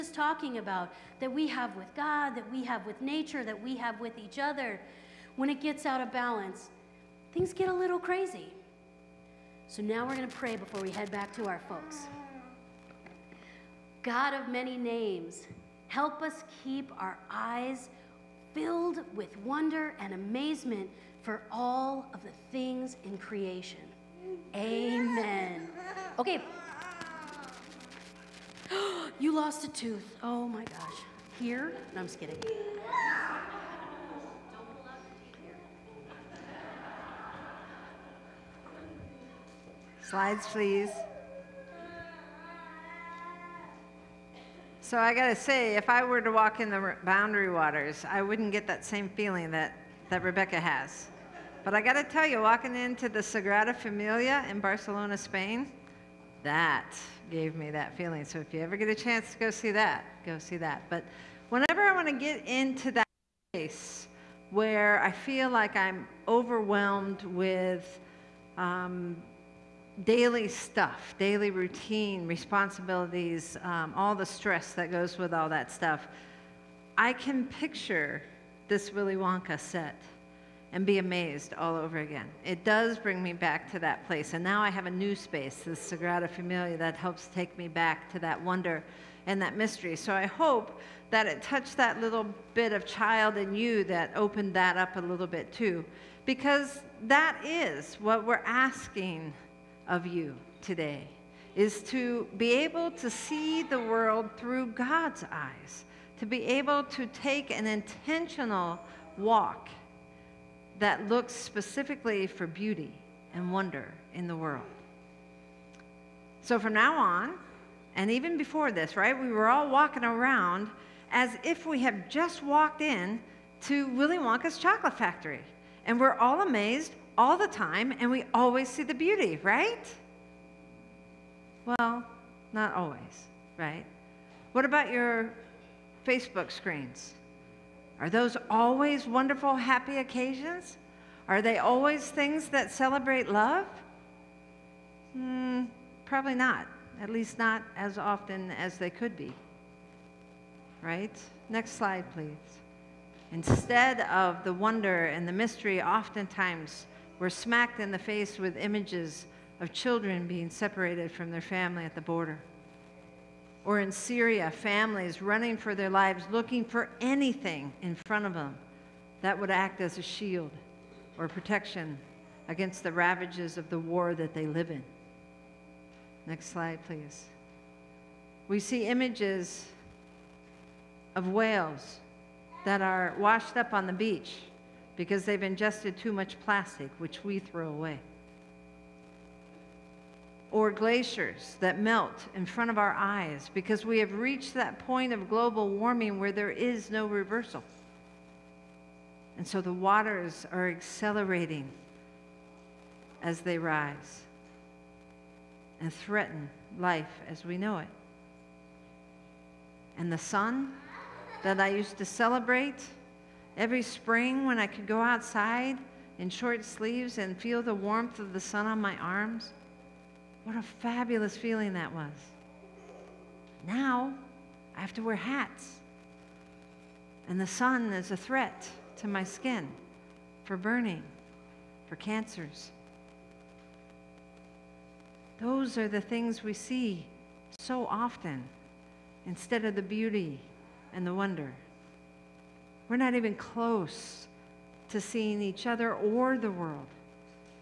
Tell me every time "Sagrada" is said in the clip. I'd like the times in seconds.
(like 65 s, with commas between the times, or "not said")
53 s, 85 s.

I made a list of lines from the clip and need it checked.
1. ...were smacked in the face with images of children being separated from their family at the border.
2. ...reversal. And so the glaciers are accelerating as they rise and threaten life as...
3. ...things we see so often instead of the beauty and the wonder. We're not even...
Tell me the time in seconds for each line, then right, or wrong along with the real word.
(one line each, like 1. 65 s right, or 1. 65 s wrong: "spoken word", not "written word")
1. 157 s right
2. 197 s wrong: "waters", not "glaciers"
3. 236 s right.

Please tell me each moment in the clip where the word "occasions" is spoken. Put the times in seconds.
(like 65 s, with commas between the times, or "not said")
139 s.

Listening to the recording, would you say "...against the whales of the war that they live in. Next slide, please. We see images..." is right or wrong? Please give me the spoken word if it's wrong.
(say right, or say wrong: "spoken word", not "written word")
wrong: "ravages", not "whales".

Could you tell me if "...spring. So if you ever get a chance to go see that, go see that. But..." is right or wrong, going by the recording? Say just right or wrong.
wrong.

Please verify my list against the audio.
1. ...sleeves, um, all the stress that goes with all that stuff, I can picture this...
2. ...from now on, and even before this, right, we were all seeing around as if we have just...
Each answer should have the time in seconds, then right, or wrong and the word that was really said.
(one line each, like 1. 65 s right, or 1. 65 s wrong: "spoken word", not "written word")
1. 72 s wrong: "responsibilities", not "sleeves"
2. 116 s wrong: "walking", not "seeing".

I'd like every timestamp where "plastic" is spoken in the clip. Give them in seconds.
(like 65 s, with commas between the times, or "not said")
186 s.